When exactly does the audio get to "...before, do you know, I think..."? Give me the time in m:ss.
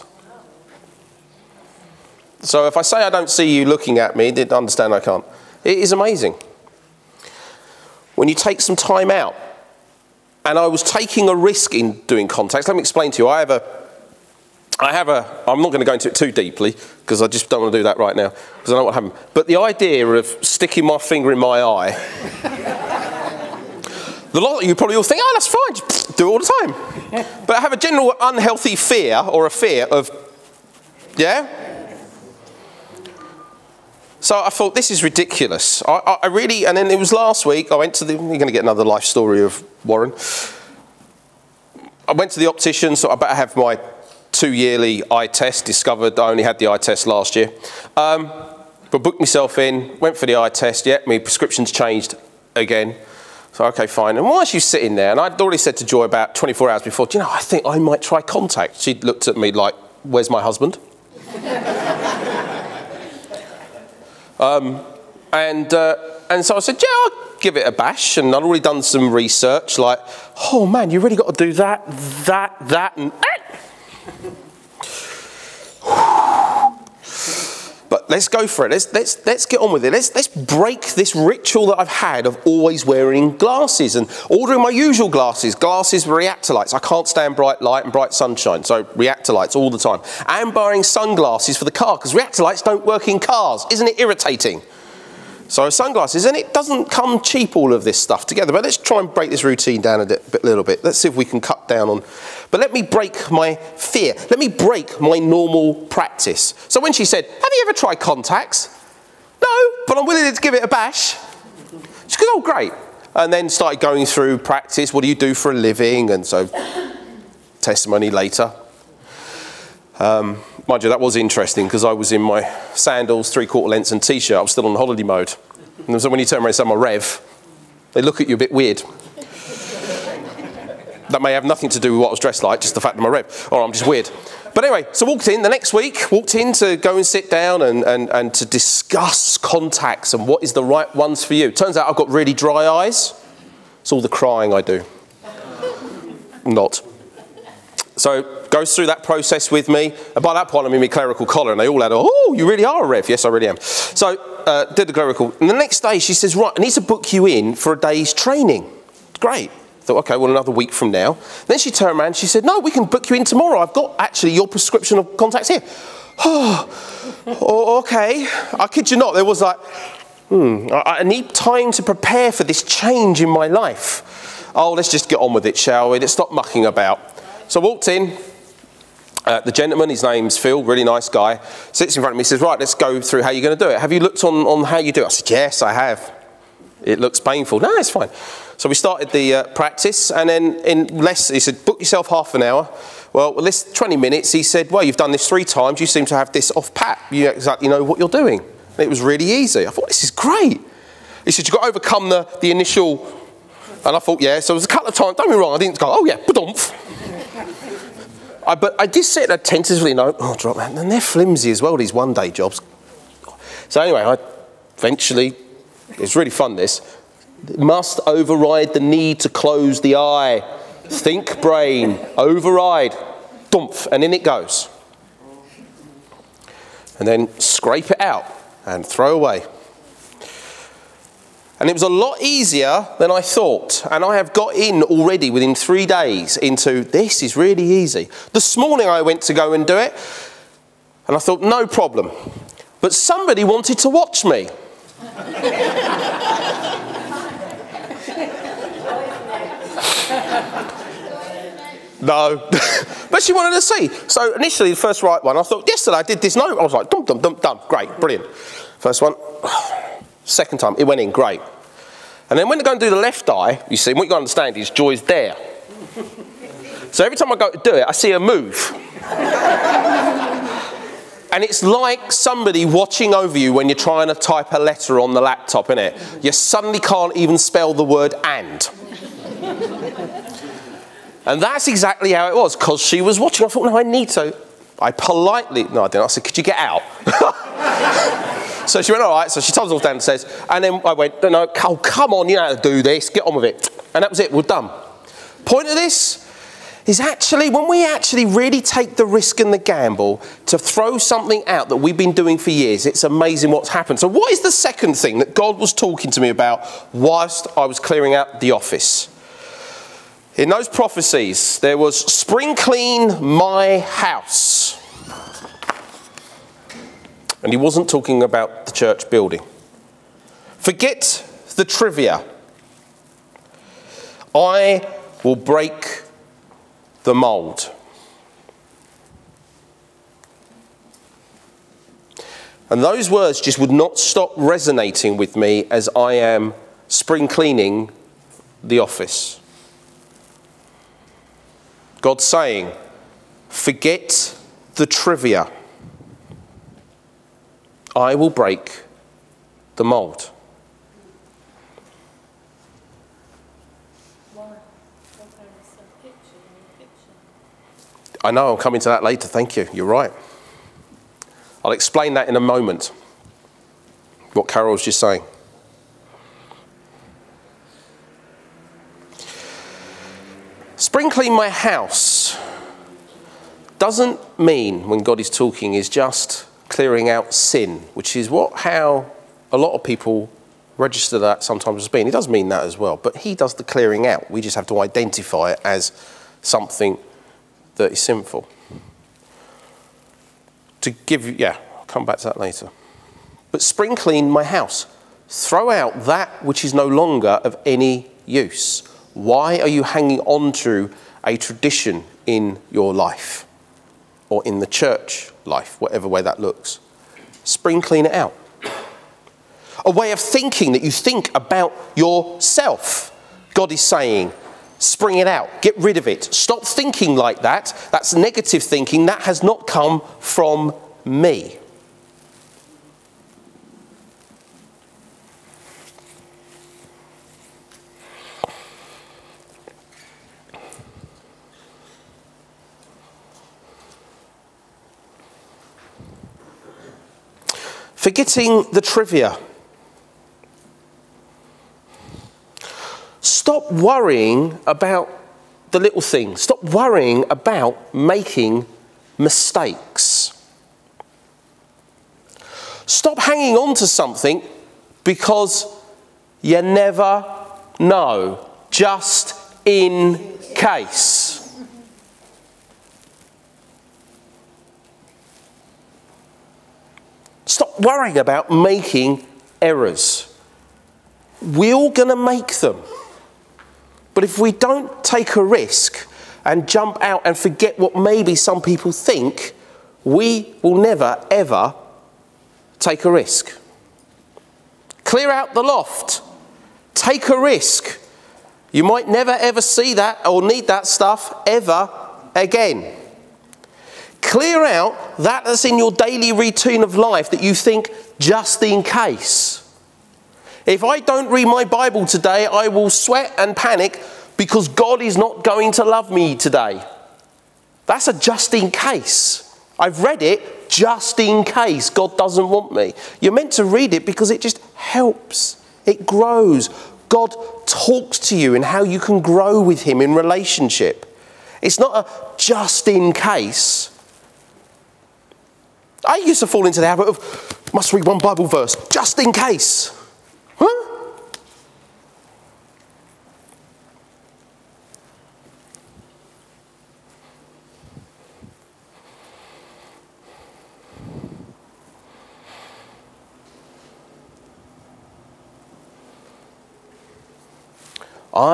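0:56.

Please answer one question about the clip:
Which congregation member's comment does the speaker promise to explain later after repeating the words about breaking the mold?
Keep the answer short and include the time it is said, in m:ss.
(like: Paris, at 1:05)
Carol, at 6:04.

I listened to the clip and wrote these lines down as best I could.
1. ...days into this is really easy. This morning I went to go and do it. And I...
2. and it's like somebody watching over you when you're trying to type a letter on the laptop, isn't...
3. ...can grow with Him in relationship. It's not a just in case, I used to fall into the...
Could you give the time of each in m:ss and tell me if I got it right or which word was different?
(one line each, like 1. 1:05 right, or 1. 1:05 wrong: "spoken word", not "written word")
1. 3:55 right
2. 4:31 right
3. 8:38 right.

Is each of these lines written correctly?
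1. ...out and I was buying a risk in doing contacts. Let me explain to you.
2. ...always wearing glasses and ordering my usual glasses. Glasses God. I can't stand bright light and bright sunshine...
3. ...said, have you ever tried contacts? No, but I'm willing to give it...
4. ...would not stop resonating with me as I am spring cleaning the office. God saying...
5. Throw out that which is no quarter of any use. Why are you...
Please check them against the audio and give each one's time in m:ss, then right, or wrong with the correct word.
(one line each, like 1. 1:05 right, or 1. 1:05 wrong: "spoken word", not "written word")
1. 0:09 wrong: "taking", not "buying"
2. 1:22 wrong: "Reactolites", not "God"
3. 1:47 right
4. 5:33 right
5. 6:35 wrong: "longer", not "quarter".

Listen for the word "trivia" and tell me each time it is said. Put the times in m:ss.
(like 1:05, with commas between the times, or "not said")
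5:21, 5:44, 7:18.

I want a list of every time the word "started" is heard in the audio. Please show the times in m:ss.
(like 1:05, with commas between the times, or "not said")
1:53, 3:08.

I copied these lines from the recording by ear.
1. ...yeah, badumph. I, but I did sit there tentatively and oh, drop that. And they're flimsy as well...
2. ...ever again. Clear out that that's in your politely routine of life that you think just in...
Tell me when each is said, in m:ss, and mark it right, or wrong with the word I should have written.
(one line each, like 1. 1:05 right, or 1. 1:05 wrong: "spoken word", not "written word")
1. 3:26 right
2. 8:11 wrong: "daily", not "politely".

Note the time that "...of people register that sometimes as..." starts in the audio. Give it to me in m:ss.
6:19.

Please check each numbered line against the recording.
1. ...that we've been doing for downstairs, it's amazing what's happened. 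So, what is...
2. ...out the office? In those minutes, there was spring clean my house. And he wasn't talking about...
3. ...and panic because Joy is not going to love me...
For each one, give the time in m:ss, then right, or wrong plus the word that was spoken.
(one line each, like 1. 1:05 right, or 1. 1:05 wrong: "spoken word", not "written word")
1. 5:01 wrong: "years", not "downstairs"
2. 5:08 wrong: "prophecies", not "minutes"
3. 8:23 wrong: "God", not "Joy".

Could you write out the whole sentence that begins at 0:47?
Um, but booked myself in, went for the eye test, yeah, my prescription's changed again.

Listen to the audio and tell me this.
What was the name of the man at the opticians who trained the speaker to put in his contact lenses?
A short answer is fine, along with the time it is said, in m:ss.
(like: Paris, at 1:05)
Phil, at 3:00.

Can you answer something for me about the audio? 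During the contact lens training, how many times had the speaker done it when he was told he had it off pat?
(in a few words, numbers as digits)
3.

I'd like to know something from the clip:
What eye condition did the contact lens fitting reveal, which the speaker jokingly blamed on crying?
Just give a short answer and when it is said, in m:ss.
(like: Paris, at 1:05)
Dry eyes, at 2:22.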